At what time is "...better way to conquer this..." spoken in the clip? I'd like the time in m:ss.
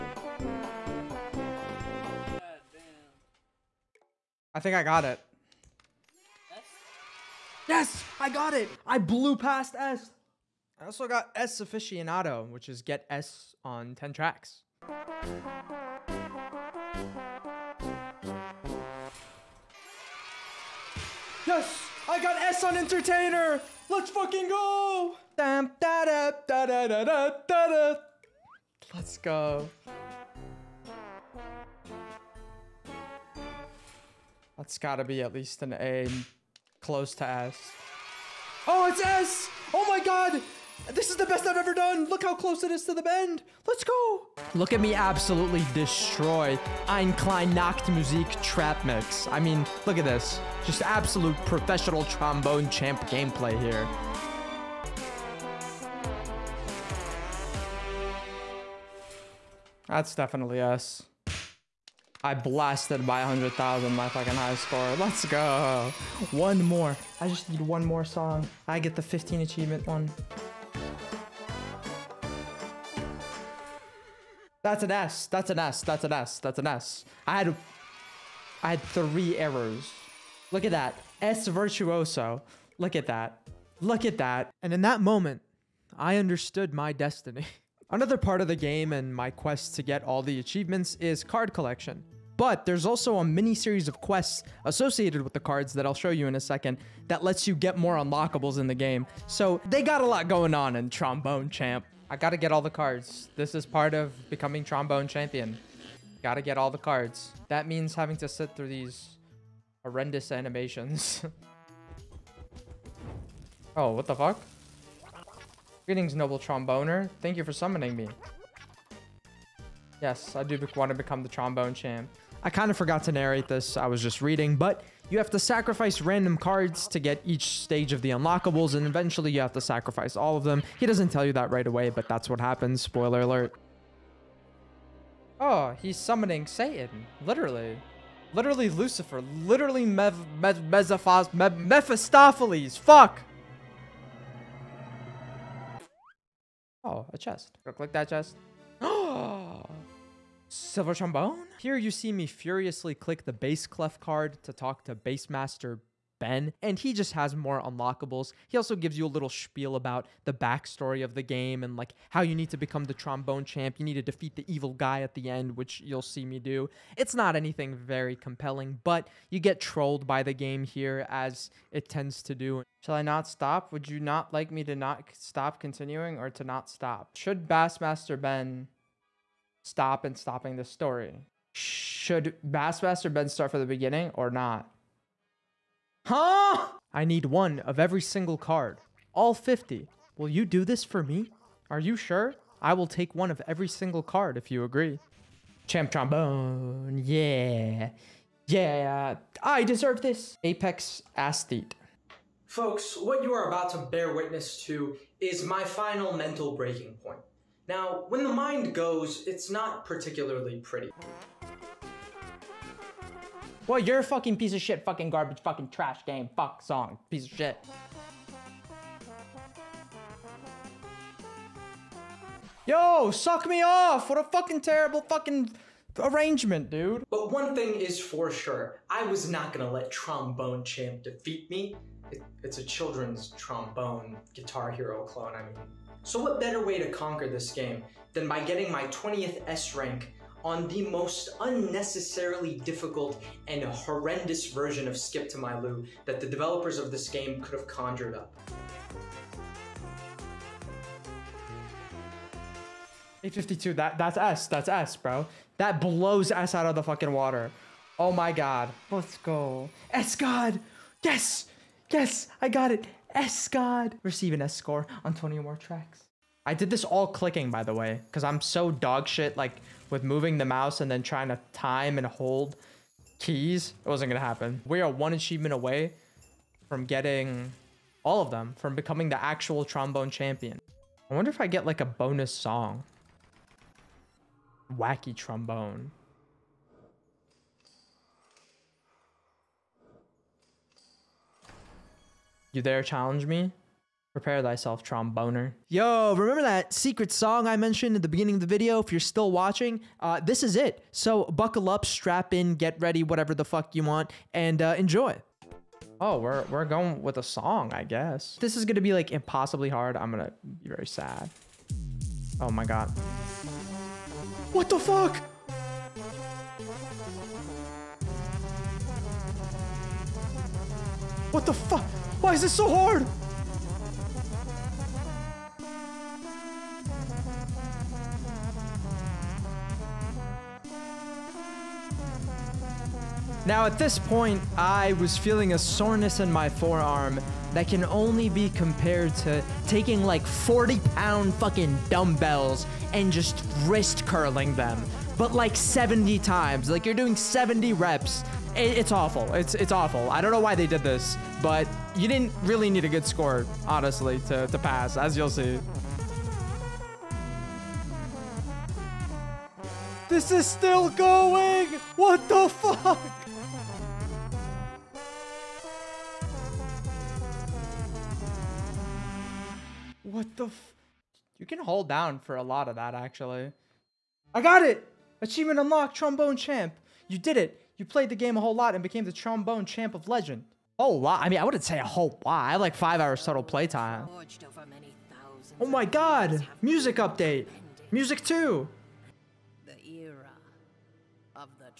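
3:56.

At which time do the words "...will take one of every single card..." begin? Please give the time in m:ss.
3:12.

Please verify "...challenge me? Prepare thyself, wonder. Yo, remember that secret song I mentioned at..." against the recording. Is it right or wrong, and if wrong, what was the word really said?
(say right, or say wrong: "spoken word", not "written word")
wrong: "tromboner", not "wonder".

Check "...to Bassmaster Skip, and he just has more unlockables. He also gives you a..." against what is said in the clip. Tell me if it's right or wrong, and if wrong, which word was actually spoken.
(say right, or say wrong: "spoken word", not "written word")
wrong: "Ben", not "Skip".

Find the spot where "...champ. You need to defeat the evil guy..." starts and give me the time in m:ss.
2:43.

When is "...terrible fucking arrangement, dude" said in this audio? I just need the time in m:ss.
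3:44.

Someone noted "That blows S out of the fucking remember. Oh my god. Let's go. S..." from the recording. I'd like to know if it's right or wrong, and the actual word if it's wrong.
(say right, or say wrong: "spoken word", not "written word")
wrong: "water", not "remember".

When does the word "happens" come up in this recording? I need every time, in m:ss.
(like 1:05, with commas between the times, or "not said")
2:12, 4:34.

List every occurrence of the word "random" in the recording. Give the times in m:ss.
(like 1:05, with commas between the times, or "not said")
2:06.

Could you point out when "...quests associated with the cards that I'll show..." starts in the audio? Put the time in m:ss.
1:33.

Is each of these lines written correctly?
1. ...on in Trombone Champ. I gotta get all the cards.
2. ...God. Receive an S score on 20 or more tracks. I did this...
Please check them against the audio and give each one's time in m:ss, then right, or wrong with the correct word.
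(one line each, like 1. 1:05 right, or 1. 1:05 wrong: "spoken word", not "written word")
1. 1:40 right
2. 4:23 right.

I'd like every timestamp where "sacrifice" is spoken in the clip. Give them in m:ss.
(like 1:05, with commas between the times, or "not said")
2:05, 2:09.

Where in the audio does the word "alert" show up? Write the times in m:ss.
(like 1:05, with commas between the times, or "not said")
2:13.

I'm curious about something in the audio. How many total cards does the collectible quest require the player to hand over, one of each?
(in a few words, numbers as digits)
50.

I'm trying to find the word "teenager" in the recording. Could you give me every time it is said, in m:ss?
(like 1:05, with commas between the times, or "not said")
not said.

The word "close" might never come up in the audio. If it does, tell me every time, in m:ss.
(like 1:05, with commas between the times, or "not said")
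0:36, 0:42.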